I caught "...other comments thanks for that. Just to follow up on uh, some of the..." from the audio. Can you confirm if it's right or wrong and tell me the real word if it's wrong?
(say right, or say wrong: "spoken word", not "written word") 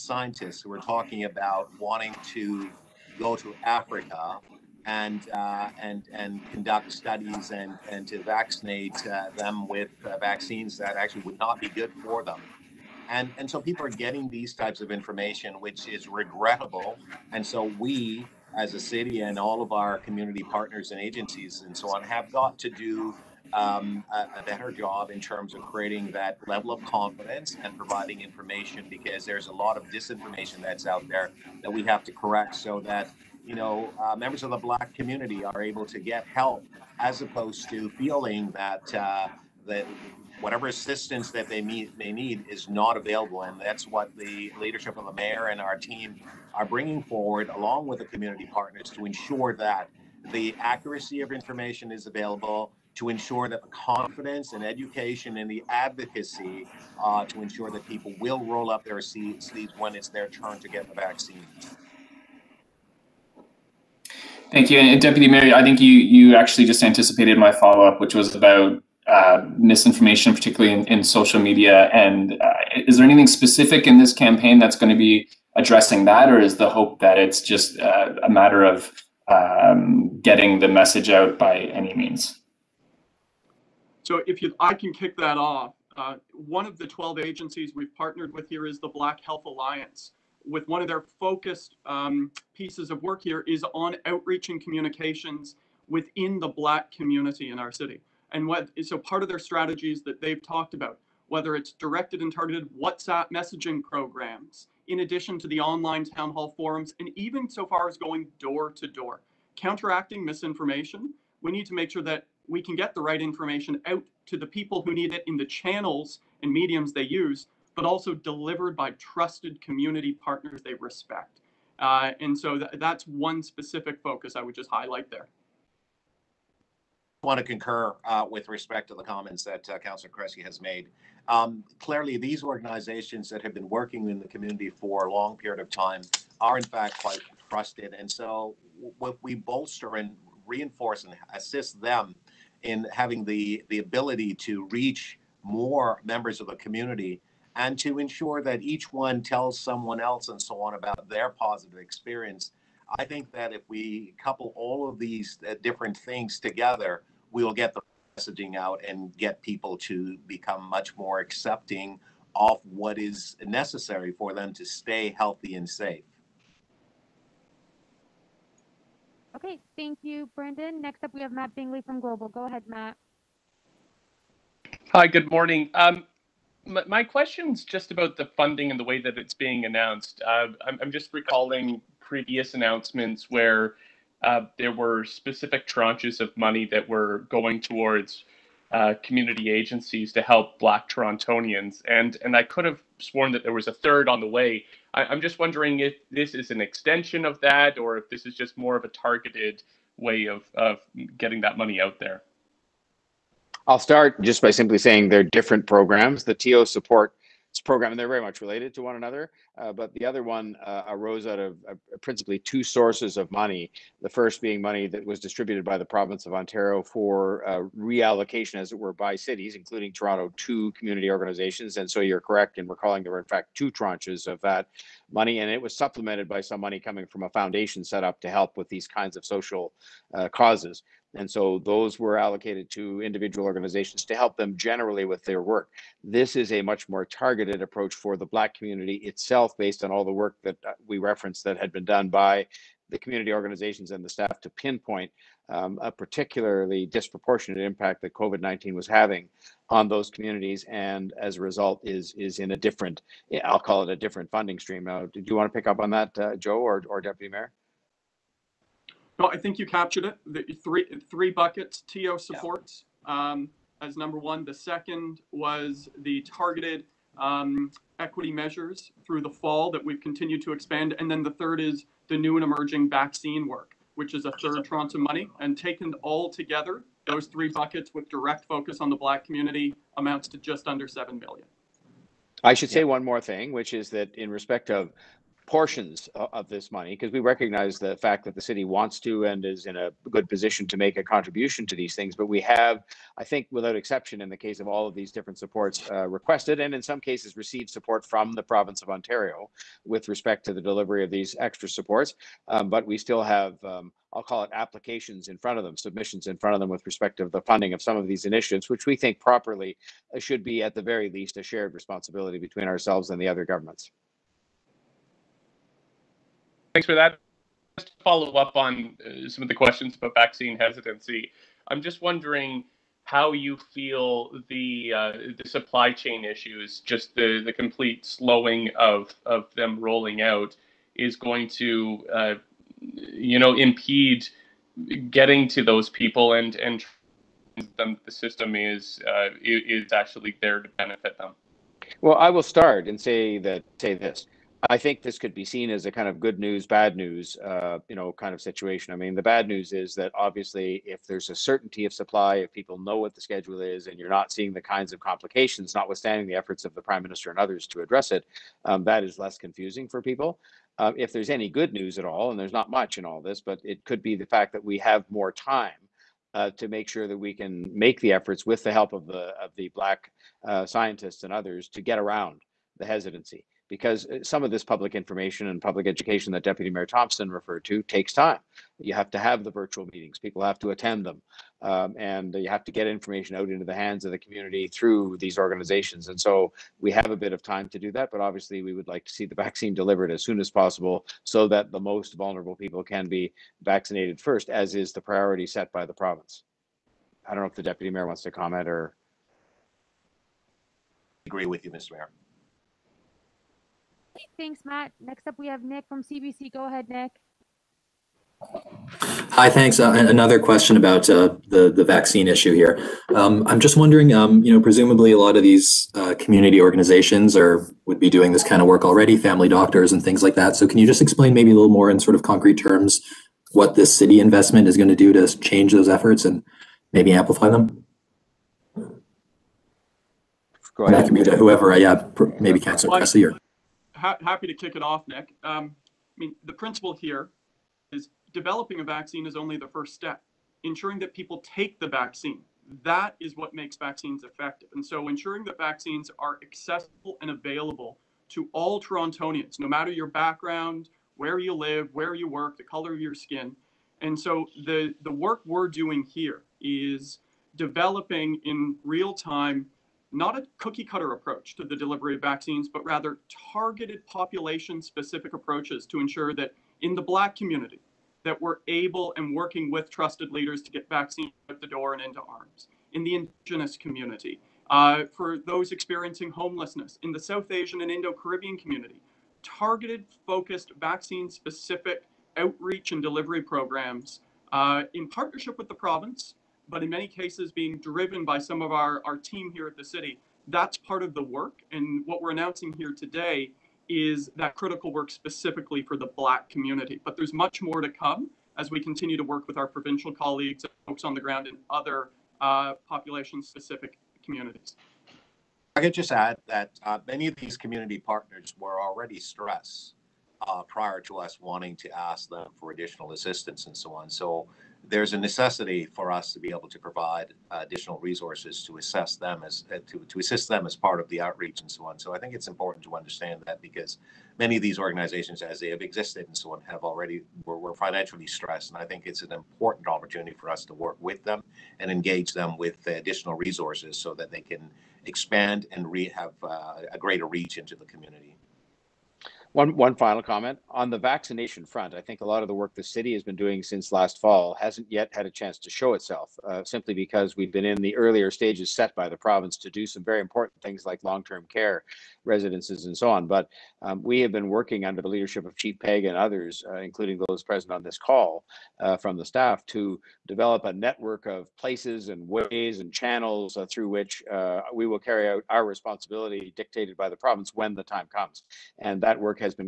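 wrong: "governments", not "comments".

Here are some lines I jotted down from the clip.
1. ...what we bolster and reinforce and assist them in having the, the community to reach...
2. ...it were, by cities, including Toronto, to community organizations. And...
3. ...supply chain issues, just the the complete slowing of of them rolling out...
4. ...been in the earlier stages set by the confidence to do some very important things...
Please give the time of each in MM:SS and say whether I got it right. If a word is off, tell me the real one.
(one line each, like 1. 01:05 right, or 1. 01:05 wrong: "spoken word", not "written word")
1. 02:18 wrong: "ability", not "community"
2. 03:38 right
3. 05:25 right
4. 09:07 wrong: "province", not "confidence".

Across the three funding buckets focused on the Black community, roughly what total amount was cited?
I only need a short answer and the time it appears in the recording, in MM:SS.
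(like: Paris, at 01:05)
just under 7 million, at 04:40.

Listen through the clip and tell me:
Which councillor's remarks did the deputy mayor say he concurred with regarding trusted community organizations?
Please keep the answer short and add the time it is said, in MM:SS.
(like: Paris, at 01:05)
Councillor Cressy, at 02:09.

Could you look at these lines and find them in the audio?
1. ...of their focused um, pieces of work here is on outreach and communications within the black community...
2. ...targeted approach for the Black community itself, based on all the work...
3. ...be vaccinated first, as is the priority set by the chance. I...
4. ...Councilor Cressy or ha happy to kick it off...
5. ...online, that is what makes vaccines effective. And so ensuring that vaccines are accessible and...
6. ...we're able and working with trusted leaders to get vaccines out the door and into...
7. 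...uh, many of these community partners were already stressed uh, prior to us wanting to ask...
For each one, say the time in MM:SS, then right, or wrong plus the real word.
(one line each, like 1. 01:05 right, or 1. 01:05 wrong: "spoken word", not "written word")
1. 01:30 right
2. 03:57 right
3. 06:33 wrong: "province", not "chance"
4. 07:12 right
5. 07:21 wrong: "vaccine", not "online"
6. 07:48 right
7. 08:26 right.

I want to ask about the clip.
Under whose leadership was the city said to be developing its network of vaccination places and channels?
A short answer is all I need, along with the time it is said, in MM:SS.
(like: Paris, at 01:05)
Chief Pegg, at 09:15.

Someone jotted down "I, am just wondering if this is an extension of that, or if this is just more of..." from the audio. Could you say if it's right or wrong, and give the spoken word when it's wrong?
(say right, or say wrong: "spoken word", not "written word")
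right.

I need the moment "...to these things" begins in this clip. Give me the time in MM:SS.
04:51.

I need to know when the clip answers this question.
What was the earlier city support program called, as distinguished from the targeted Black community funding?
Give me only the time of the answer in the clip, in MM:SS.
03:26.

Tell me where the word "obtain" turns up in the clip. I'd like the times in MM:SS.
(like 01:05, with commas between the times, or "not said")
not said.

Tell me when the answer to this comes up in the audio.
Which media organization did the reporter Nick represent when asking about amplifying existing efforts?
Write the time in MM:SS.
06:46.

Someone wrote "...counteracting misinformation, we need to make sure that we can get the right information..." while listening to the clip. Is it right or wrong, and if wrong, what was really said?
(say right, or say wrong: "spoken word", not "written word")
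right.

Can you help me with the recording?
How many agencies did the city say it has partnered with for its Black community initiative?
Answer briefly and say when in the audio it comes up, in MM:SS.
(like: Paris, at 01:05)
12, at 01:26.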